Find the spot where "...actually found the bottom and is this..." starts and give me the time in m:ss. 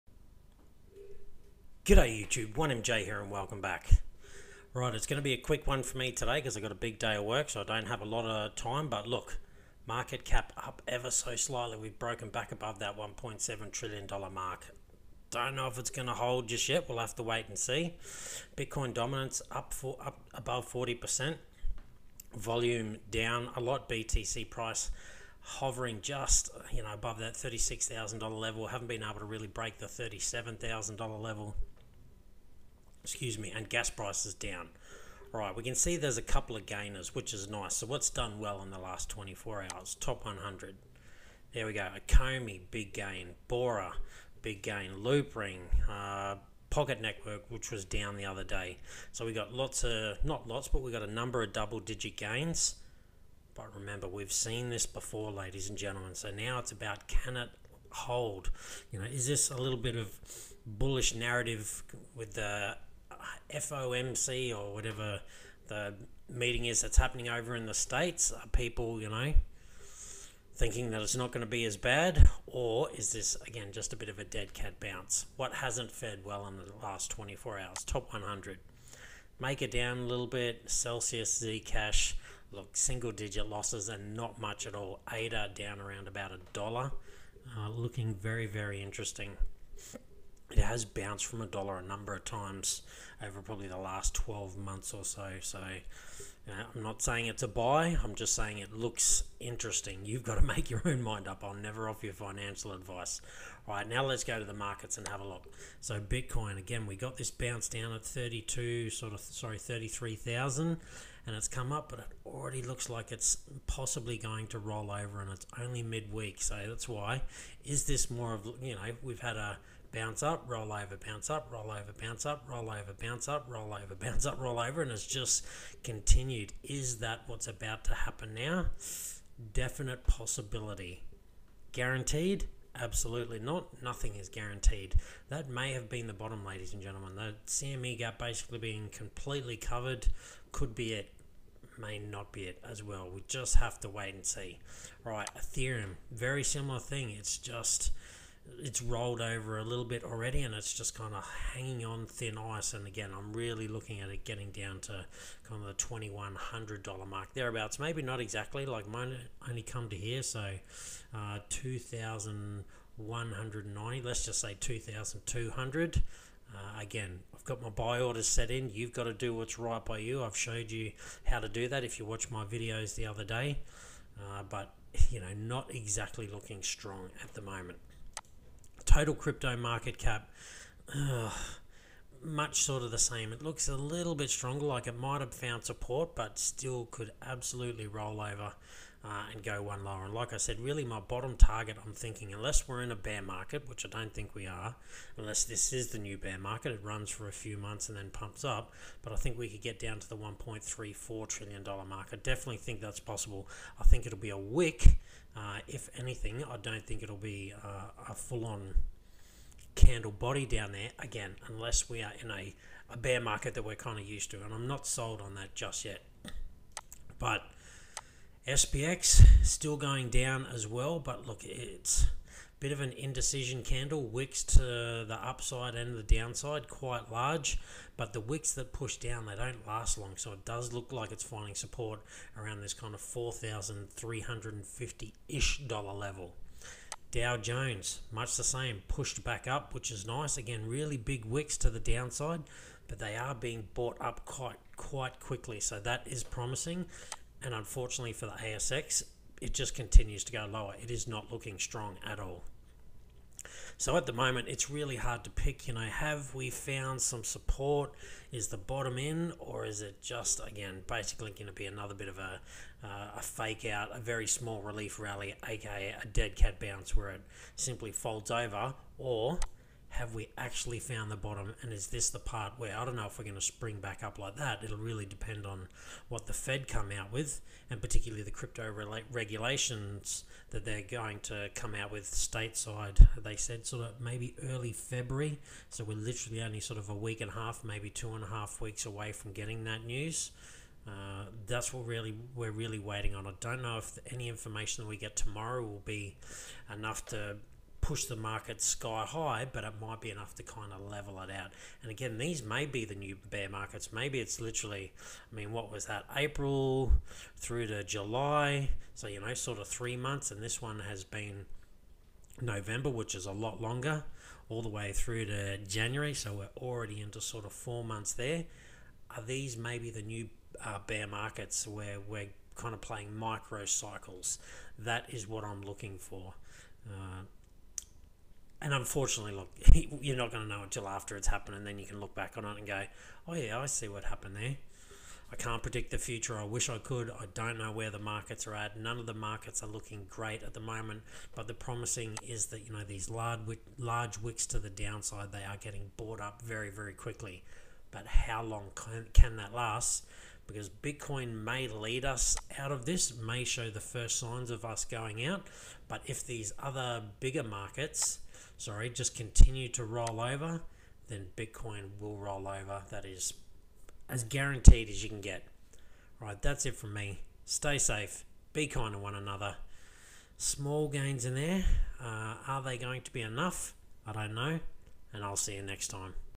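4:30.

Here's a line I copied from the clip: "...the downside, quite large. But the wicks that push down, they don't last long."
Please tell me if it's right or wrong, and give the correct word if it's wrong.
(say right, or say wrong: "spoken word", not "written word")
right.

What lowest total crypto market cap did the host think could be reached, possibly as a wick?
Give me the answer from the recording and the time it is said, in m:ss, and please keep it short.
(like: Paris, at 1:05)
$1.34 trillion, at 3:20.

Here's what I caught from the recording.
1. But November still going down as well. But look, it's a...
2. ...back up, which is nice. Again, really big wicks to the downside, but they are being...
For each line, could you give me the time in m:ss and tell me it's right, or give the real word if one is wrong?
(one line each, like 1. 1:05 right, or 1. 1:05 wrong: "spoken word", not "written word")
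1. 3:37 wrong: "SPX", not "November"
2. 3:59 right.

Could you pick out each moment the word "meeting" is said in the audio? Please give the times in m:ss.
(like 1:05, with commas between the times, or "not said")
1:06.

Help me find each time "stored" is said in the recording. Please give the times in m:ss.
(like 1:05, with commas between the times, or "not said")
not said.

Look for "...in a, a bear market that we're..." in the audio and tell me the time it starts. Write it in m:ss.
3:32.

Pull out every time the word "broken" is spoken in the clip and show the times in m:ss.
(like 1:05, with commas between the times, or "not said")
0:11.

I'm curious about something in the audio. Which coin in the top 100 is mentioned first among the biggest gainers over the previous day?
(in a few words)
Akomi.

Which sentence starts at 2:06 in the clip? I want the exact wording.
Is that what's about to happen now?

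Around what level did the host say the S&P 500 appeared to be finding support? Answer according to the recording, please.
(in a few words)
4,350.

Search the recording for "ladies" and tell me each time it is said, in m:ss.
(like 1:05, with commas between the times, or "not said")
0:55, 2:16.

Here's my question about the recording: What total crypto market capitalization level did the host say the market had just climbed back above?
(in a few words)
$1.7 trillion.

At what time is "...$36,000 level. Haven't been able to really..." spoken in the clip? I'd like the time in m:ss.
0:27.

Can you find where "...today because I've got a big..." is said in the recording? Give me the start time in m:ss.
0:06.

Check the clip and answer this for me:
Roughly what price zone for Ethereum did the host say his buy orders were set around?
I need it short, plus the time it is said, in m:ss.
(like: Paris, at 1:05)
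2,200, at 2:44.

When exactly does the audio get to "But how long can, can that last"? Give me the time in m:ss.
5:47.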